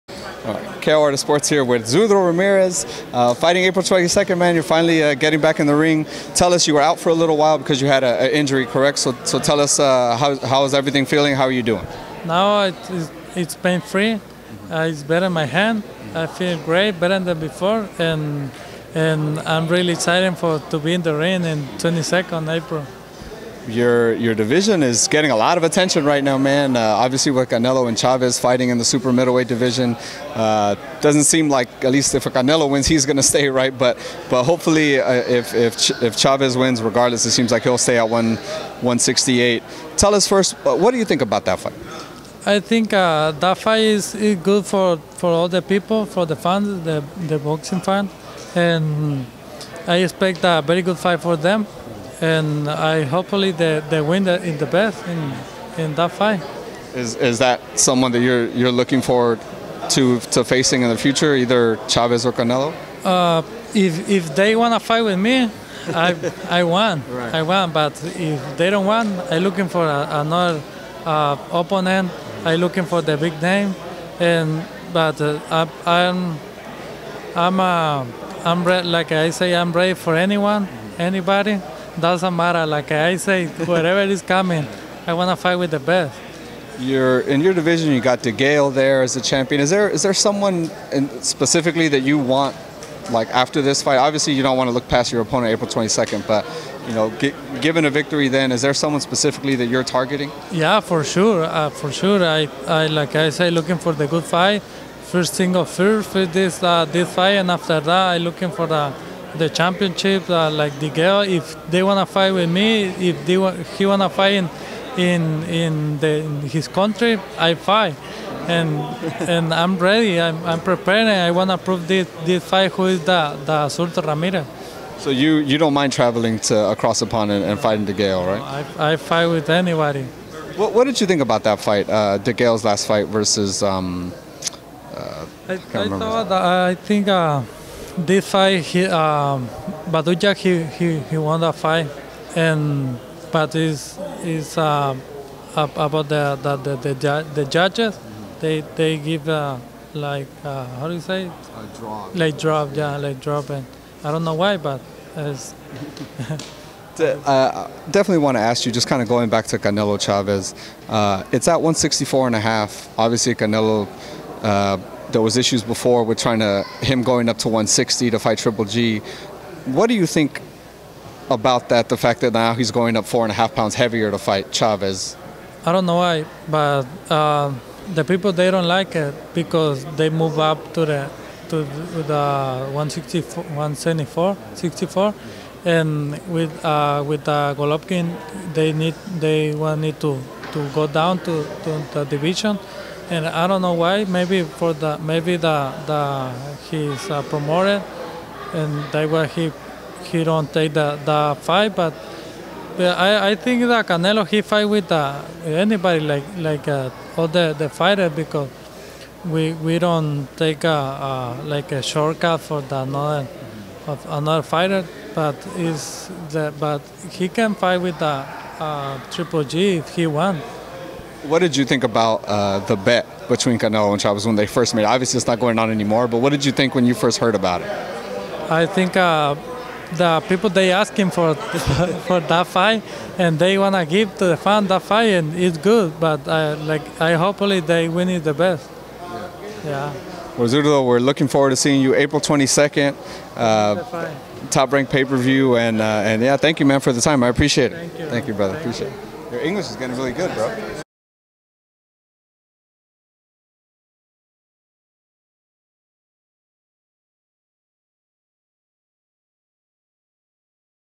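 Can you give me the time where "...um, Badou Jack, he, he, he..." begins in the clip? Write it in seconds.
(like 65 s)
138 s.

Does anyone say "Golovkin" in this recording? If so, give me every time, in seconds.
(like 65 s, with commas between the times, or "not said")
187 s.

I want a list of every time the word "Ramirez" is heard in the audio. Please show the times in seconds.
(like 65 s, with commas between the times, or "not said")
2 s, 124 s.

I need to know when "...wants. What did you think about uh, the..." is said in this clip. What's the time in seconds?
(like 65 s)
220 s.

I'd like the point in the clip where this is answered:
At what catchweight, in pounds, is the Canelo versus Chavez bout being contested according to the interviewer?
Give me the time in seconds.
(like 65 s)
161 s.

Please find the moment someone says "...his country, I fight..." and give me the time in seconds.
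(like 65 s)
116 s.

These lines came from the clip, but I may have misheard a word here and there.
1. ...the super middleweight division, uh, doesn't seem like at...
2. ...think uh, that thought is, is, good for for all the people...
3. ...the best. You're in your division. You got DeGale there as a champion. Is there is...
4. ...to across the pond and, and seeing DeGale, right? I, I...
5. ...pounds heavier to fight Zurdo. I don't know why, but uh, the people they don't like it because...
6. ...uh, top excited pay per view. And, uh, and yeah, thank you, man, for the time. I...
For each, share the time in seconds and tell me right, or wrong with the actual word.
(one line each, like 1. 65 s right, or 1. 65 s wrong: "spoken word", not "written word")
1. 28 s right
2. 42 s wrong: "fight", not "thought"
3. 85 s right
4. 126 s wrong: "fighting", not "seeing"
5. 173 s wrong: "Chavez", not "Zurdo"
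6. 243 s wrong: "ranked", not "excited".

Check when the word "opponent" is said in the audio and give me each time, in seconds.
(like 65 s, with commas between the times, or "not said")
71 s, 95 s.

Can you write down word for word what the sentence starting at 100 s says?
Yeah, for sure, uh, for sure.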